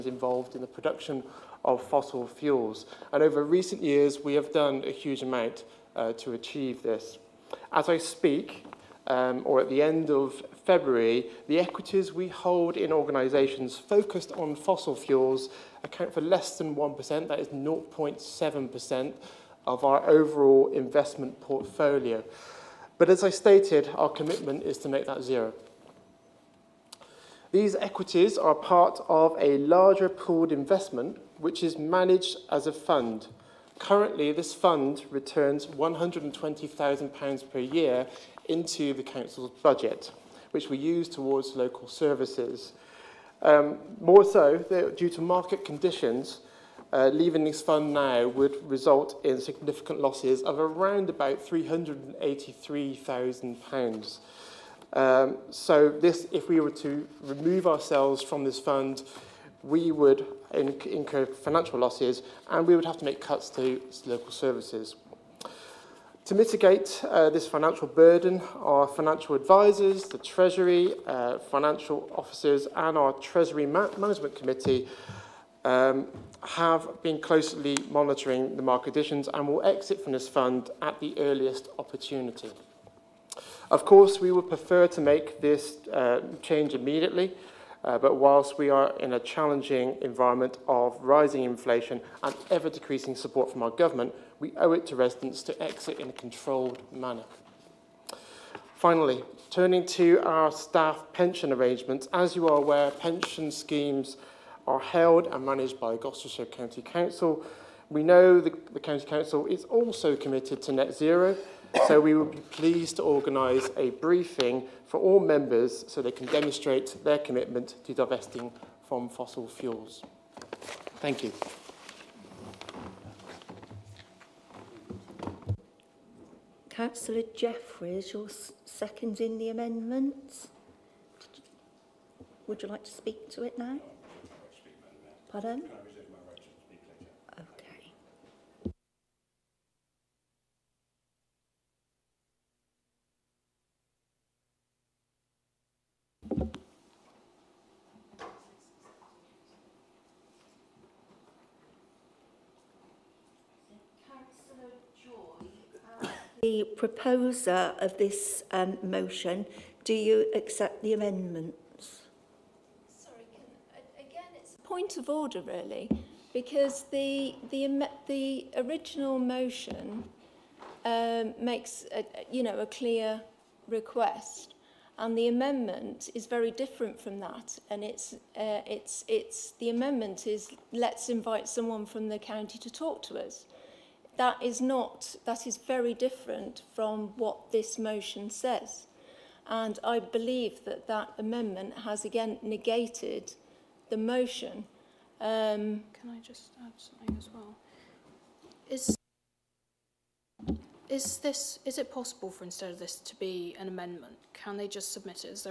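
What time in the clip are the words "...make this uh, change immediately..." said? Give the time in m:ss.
1:25.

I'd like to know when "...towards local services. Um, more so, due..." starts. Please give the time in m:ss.
0:41.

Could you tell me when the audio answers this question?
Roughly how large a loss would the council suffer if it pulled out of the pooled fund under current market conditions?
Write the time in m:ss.
0:51.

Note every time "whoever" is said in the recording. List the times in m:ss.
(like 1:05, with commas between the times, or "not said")
not said.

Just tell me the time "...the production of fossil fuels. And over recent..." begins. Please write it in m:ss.
0:00.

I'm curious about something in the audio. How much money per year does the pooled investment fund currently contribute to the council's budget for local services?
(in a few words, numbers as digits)
£120,000.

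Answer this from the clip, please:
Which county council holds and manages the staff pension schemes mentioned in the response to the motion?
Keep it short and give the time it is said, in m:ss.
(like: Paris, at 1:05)
Gloucestershire County Council, at 1:45.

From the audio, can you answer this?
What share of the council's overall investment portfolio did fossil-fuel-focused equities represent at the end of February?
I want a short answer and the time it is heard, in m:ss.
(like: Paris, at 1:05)
0.7%, at 0:17.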